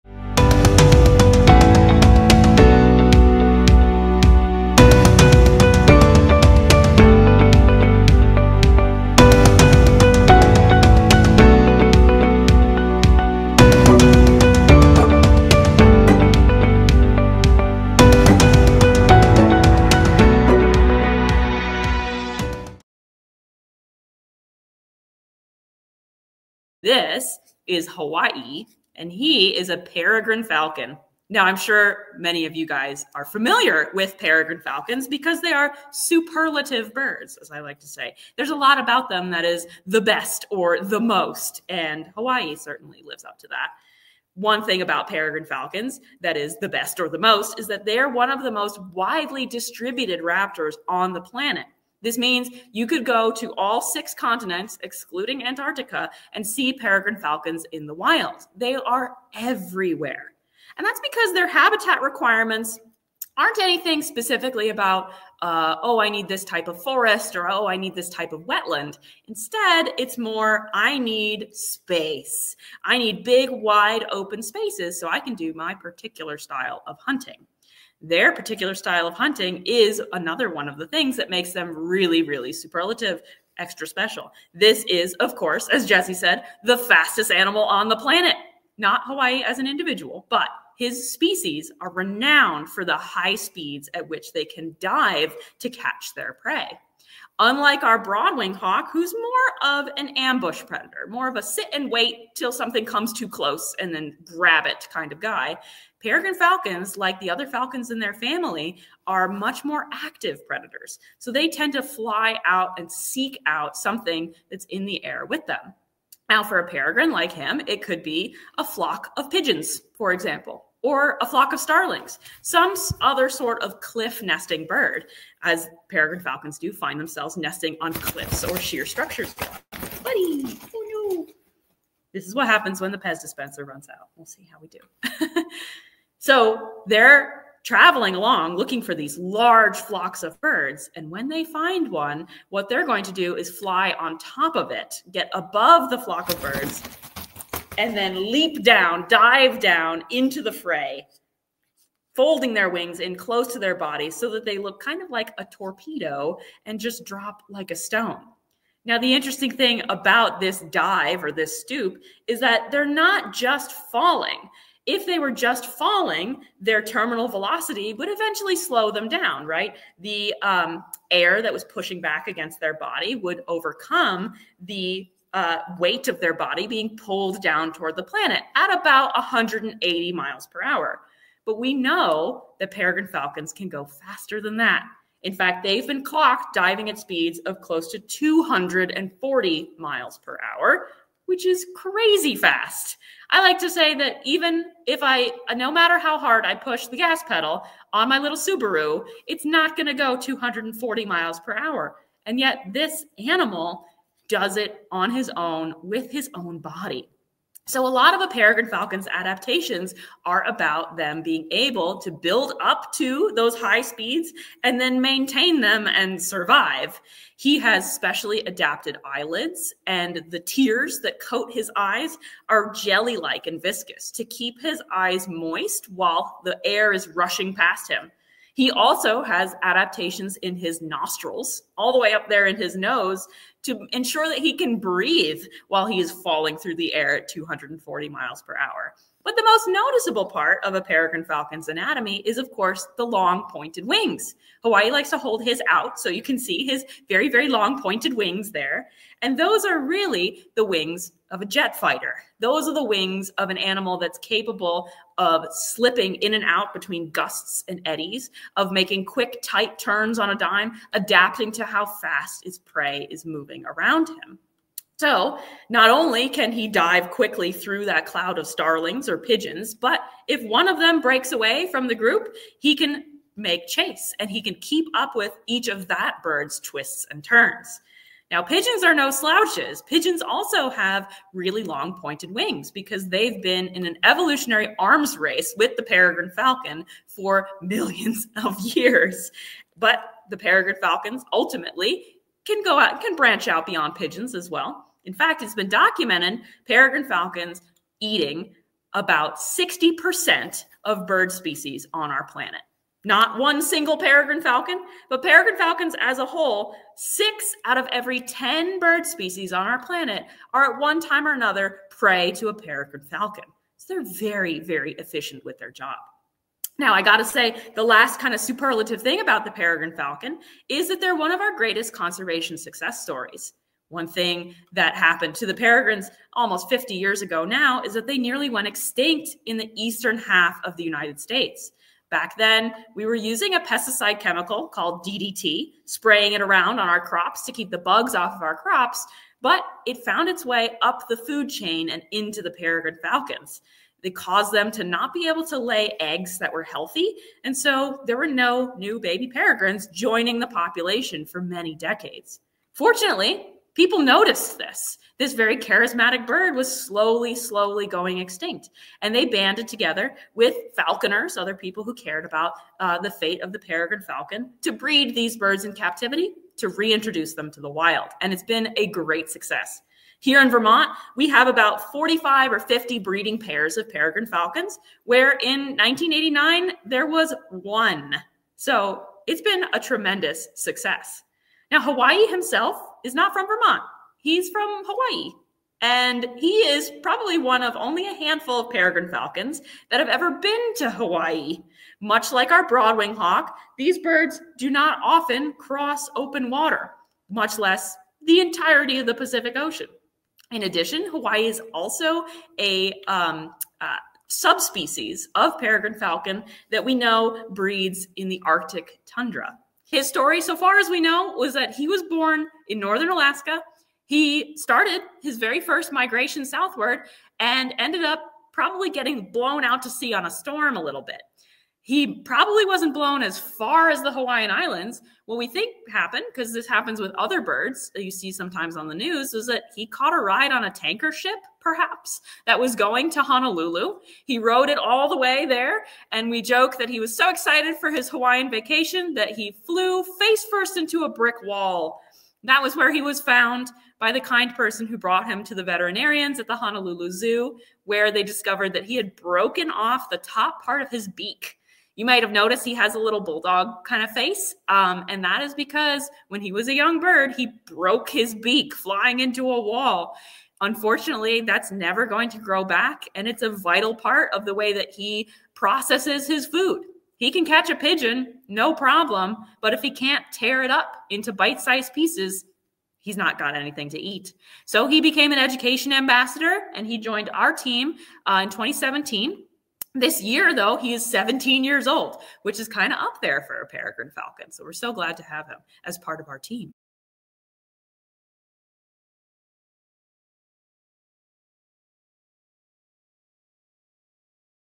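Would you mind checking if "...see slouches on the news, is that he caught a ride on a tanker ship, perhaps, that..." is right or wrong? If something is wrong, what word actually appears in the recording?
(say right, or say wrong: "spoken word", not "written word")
wrong: "sometimes", not "slouches".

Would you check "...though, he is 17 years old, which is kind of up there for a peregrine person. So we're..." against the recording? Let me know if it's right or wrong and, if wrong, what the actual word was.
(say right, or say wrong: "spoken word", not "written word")
wrong: "falcon", not "person".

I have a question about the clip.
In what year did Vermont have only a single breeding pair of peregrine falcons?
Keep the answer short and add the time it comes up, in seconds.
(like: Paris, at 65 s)
1989, at 375 s.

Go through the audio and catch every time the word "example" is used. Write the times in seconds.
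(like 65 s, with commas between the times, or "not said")
120 s.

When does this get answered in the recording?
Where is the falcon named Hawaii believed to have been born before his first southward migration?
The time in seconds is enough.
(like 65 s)
412 s.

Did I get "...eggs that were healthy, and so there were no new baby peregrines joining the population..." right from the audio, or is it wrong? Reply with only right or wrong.
right.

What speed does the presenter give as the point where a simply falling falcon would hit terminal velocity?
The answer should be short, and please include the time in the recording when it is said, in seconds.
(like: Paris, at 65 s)
180 miles per hour, at 179 s.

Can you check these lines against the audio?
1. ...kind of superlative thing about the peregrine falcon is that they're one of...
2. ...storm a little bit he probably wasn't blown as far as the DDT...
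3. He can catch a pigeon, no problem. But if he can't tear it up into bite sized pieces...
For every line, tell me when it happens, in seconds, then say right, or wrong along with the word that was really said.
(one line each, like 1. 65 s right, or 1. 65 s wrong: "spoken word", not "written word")
1. 318 s right
2. 420 s wrong: "Hawaiian", not "DDT"
3. 467 s right.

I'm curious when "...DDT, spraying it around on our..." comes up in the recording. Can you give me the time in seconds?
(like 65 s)
335 s.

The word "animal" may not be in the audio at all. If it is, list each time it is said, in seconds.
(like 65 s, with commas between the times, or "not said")
87 s, 203 s, 253 s.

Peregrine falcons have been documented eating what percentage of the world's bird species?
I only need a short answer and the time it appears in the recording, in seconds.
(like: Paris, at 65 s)
60%, at 299 s.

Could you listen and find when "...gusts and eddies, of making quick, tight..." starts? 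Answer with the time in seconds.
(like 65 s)
257 s.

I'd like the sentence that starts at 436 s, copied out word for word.
And we joke that he was so excited for his Hawaiian vacation that he flew face first into a brick wall.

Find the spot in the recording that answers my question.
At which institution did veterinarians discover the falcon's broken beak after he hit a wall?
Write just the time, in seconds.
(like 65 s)
446 s.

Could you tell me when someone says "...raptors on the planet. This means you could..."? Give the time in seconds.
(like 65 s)
50 s.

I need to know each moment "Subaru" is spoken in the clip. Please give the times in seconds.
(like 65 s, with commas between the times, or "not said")
198 s.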